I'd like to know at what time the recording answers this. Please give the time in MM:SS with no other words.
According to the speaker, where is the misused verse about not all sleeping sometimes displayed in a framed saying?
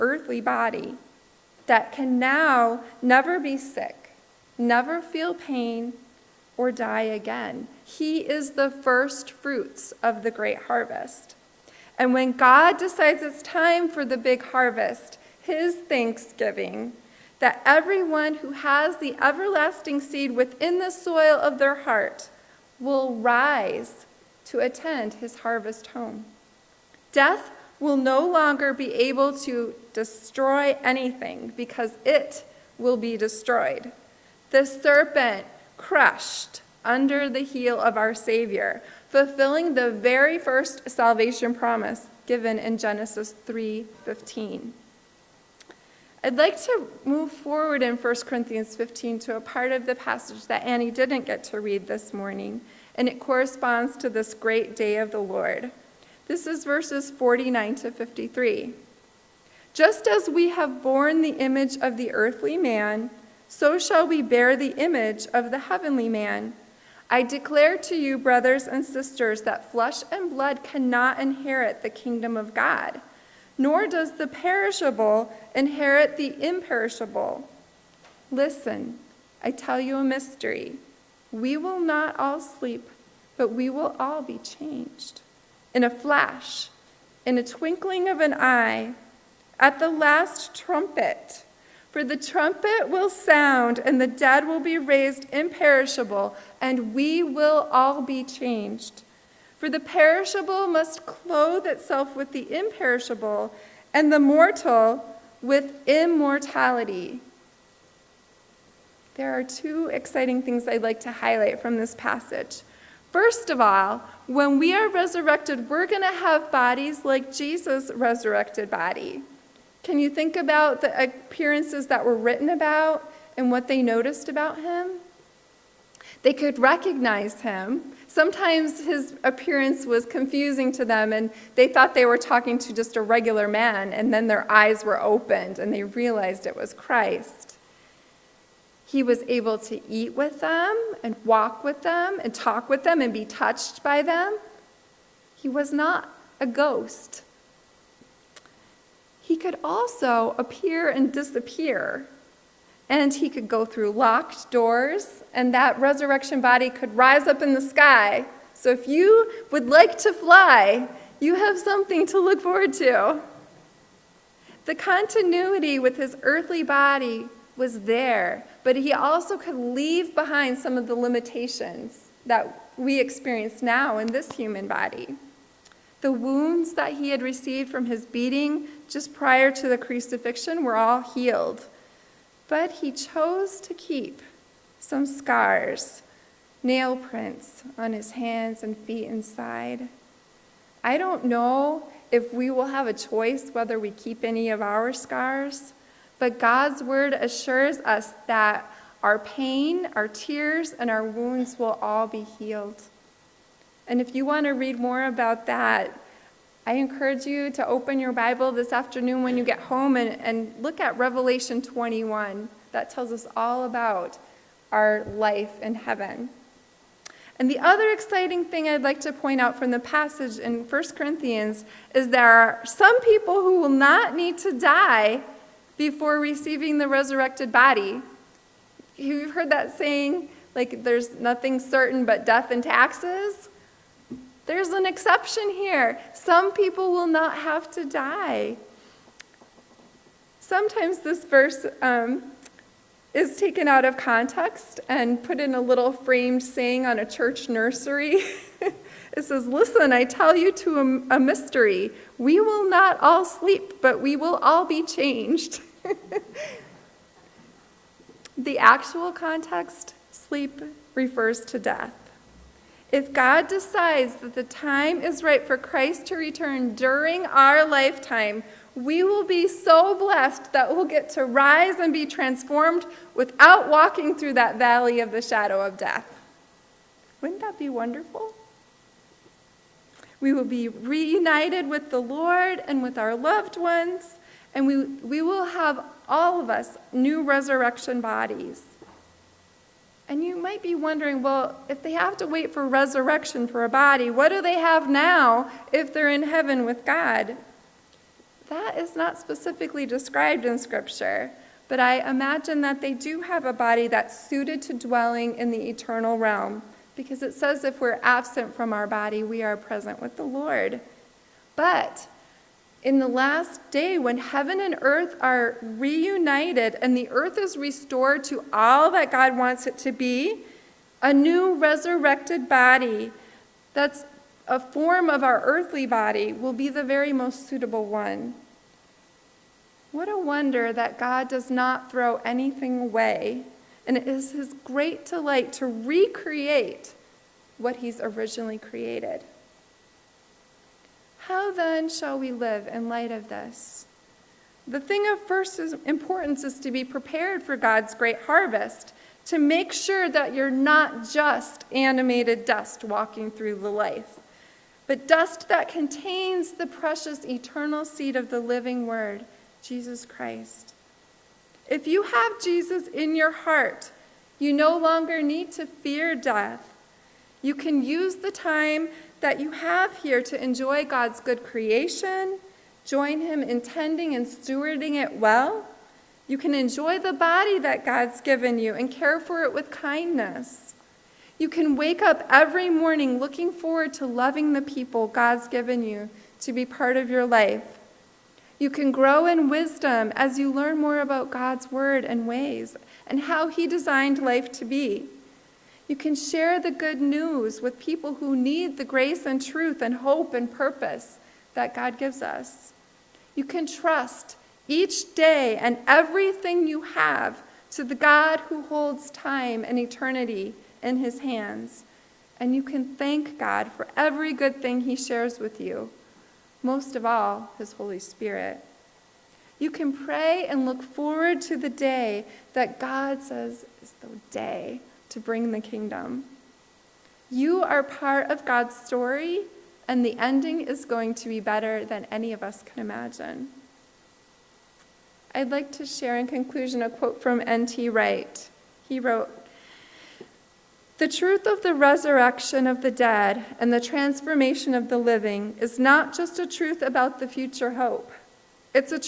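04:07.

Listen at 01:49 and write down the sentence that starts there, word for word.
There are two exciting things I'd like to highlight from this passage.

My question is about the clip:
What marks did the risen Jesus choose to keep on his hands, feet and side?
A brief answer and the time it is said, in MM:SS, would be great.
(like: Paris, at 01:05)
Nail prints, at 03:06.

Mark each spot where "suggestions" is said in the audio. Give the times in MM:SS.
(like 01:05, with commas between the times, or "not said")
not said.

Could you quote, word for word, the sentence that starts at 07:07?
You are part of God's story, and the ending is going to be better than any of us can imagine.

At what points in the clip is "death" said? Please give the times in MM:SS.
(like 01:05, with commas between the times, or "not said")
00:27, 03:52, 04:21, 04:35, 06:06.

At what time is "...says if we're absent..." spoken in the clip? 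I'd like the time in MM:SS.
05:07.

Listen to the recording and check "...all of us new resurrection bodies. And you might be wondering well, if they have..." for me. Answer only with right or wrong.
right.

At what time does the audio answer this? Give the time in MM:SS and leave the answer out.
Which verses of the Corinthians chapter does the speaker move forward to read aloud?
00:56.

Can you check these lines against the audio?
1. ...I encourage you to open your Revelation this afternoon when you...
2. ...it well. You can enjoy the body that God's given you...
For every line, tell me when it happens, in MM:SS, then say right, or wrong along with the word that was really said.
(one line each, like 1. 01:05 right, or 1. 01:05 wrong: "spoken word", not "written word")
1. 03:26 wrong: "Bible", not "Revelation"
2. 06:15 right.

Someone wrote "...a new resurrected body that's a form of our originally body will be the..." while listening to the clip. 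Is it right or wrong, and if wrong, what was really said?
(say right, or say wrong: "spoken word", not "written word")
wrong: "earthly", not "originally".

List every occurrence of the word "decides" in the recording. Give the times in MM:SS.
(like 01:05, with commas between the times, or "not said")
00:12, 04:23.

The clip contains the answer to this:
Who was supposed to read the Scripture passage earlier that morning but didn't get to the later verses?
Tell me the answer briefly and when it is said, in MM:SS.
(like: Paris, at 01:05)
Annie, at 00:50.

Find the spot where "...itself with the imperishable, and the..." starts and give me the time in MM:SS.
01:41.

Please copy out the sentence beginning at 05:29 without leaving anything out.
What a wonder that God does not throw anything away, and it is his great delight to recreate what he's originally created.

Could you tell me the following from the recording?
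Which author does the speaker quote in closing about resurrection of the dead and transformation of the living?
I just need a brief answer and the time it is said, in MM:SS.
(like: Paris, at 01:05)
N.T. Wright, at 07:17.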